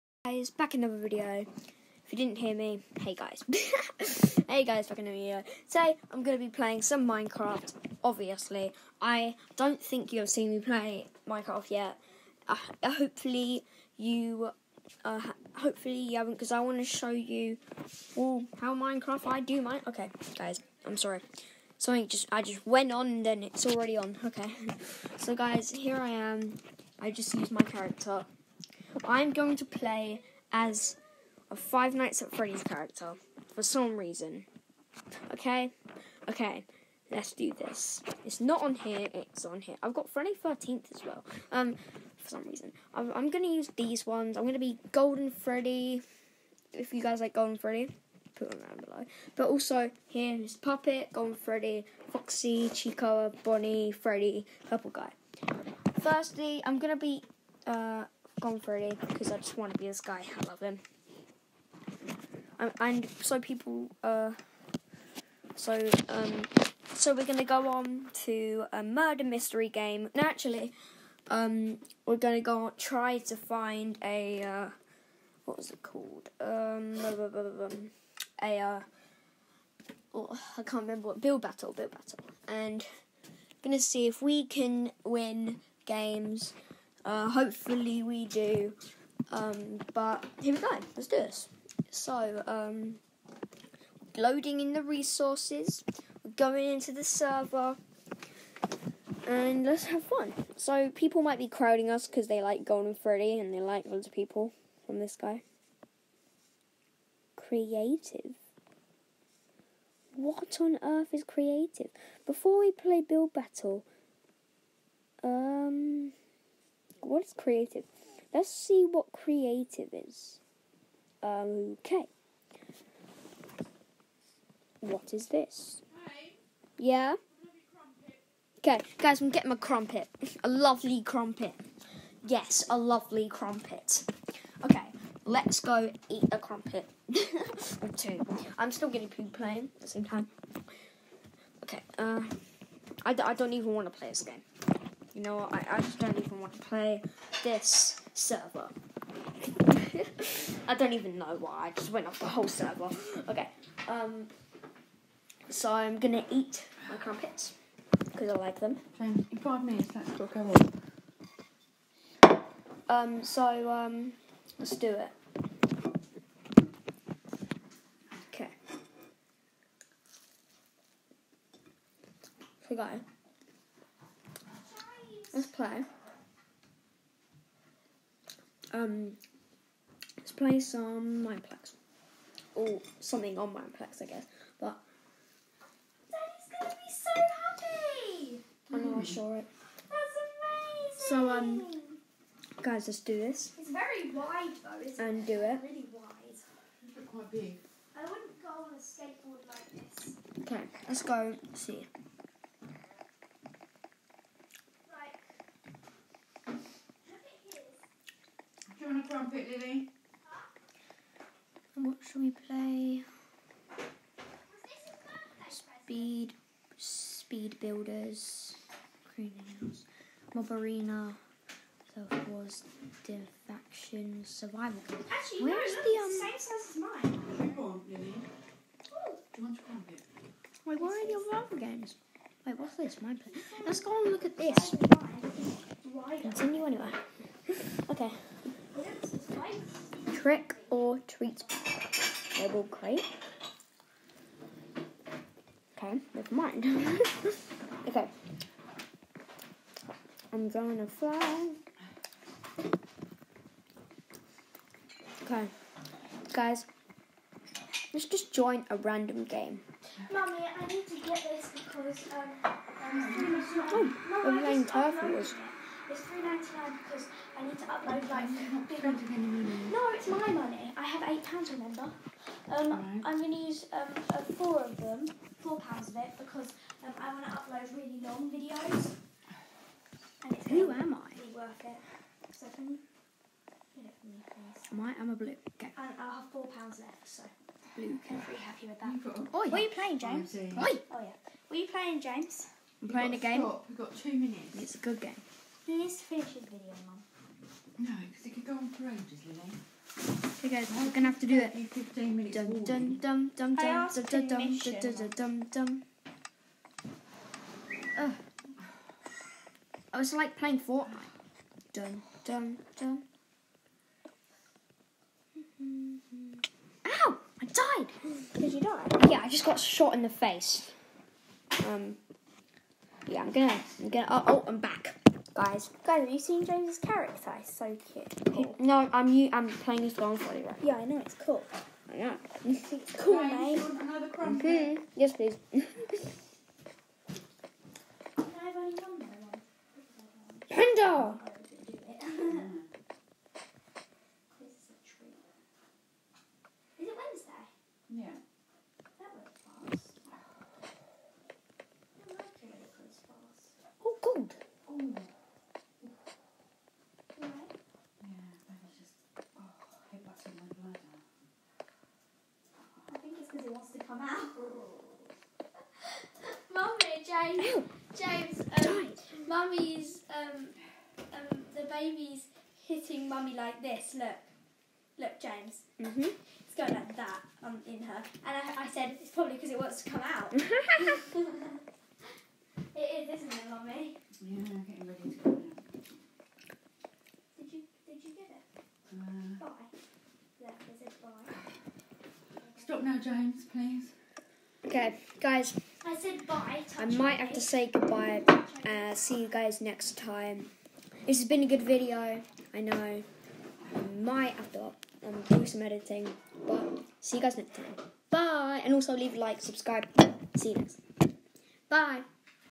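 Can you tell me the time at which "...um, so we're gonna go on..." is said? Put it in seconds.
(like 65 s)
66 s.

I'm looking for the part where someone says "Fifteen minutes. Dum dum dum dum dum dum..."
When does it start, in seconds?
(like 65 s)
301 s.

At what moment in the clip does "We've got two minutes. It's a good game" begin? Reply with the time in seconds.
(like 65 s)
293 s.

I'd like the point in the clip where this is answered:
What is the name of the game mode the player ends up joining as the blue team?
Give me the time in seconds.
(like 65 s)
264 s.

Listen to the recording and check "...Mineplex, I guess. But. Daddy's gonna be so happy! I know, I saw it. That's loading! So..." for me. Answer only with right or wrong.
wrong.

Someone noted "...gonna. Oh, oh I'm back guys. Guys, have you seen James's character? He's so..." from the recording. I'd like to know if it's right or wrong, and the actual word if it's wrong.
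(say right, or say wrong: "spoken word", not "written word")
right.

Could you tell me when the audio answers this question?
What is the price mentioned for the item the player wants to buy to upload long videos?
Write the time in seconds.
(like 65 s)
266 s.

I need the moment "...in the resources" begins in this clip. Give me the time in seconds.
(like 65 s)
94 s.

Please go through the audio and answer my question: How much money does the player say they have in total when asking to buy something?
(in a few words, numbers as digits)
8 pounds.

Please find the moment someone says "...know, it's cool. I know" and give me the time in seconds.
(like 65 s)
330 s.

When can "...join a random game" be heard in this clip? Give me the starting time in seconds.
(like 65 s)
258 s.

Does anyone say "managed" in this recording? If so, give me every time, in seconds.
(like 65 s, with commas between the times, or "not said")
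not said.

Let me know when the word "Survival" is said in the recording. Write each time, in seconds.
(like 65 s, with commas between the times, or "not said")
224 s.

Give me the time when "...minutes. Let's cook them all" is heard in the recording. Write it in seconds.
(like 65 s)
159 s.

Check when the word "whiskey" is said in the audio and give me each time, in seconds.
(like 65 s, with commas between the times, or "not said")
not said.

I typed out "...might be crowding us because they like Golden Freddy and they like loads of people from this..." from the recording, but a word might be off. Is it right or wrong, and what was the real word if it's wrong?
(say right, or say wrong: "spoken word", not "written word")
right.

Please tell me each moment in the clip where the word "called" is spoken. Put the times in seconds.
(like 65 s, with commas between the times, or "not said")
75 s.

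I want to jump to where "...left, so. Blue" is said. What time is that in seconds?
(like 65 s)
286 s.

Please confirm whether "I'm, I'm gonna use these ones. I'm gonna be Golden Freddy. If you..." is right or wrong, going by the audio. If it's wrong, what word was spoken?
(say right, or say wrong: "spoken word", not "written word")
right.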